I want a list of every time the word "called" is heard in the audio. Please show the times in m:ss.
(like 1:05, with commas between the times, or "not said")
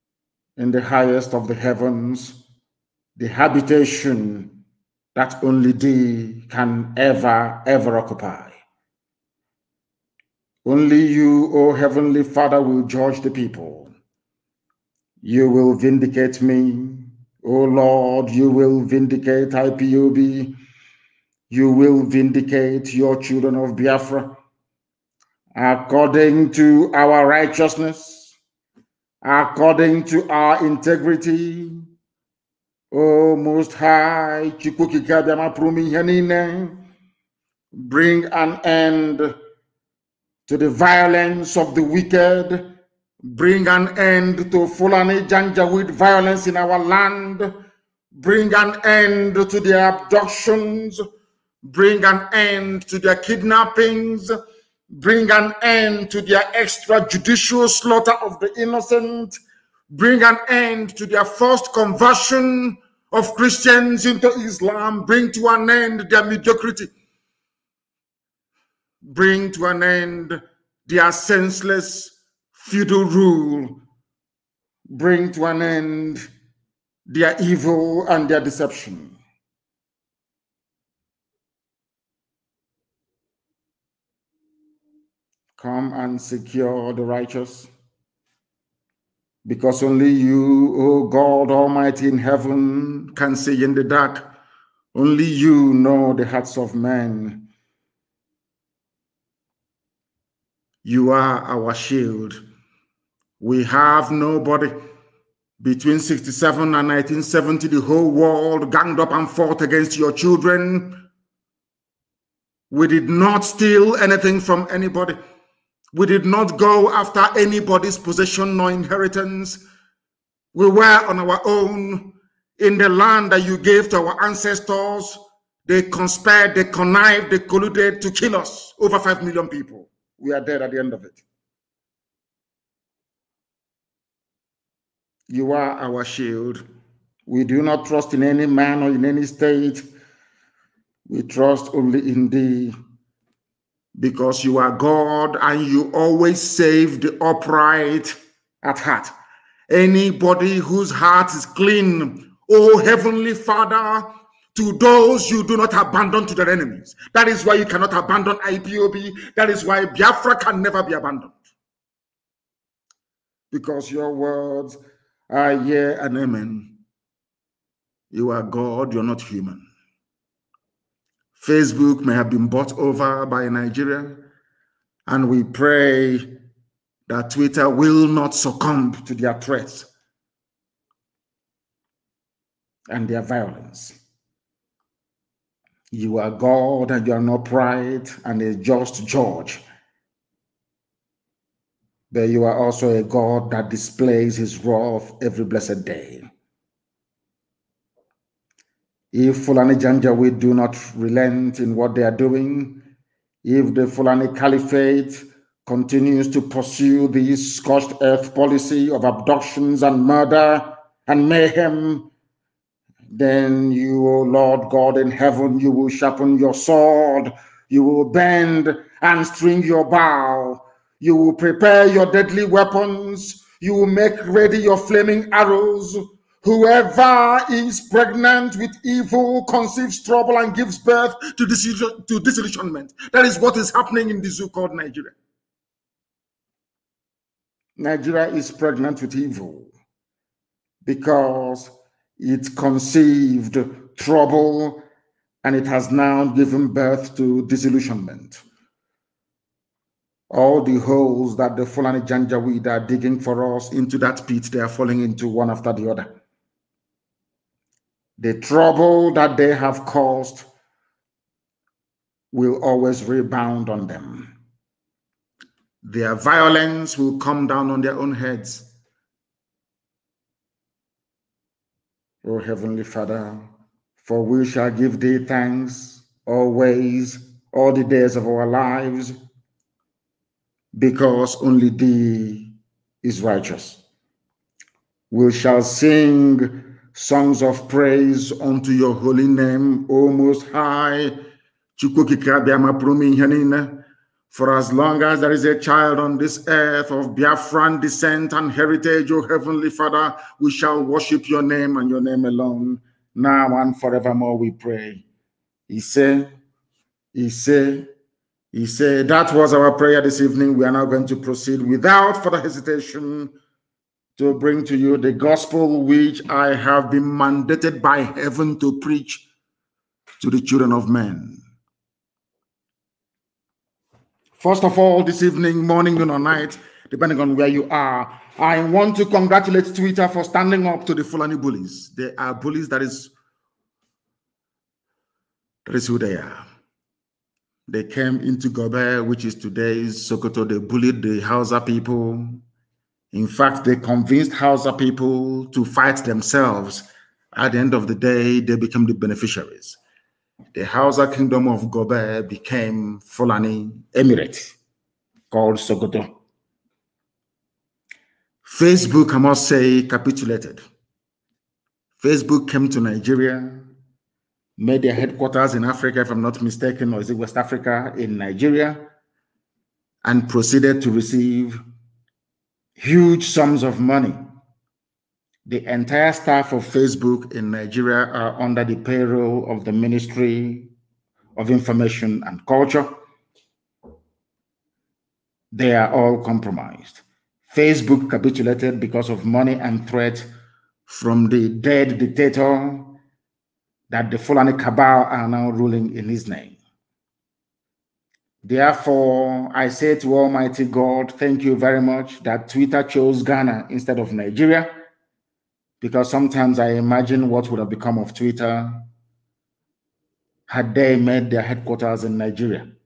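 3:54, 5:55.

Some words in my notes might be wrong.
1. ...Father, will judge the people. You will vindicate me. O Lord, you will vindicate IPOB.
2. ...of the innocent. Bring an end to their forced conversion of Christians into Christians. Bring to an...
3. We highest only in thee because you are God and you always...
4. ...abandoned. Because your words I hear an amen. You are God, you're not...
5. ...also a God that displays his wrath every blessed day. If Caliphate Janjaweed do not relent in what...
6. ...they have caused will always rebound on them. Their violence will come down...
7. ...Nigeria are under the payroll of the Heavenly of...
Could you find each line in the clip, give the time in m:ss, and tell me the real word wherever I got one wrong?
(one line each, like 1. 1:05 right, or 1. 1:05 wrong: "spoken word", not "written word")
1. 0:12 right
2. 0:58 wrong: "Islam", not "Christians"
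3. 2:21 wrong: "trust", not "highest"
4. 2:40 right
5. 3:12 wrong: "Fulani", not "Caliphate"
6. 4:19 right
7. 6:17 wrong: "Ministry", not "Heavenly".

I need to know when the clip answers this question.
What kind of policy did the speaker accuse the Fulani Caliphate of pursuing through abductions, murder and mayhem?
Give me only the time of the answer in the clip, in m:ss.
3:27.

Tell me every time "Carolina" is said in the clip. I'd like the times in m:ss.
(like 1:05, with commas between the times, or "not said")
not said.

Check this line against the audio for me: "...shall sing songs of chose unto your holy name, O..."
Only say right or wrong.
wrong.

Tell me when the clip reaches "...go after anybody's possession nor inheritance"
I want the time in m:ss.
1:56.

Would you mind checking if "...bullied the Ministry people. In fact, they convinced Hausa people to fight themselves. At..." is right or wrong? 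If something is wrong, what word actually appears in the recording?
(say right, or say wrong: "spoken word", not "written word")
wrong: "Hausa", not "Ministry".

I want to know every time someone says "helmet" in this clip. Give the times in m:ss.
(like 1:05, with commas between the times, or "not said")
not said.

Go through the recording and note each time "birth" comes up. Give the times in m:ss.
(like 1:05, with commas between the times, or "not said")
3:50, 4:06.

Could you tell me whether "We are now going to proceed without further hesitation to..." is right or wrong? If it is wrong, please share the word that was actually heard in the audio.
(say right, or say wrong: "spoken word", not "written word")
right.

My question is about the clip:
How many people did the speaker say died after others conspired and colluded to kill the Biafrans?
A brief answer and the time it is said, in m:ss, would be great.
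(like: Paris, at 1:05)
5 million, at 2:08.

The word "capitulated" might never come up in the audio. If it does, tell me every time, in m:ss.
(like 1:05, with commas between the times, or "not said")
5:59, 6:28.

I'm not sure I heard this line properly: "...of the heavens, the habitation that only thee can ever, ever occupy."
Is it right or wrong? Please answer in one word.
right.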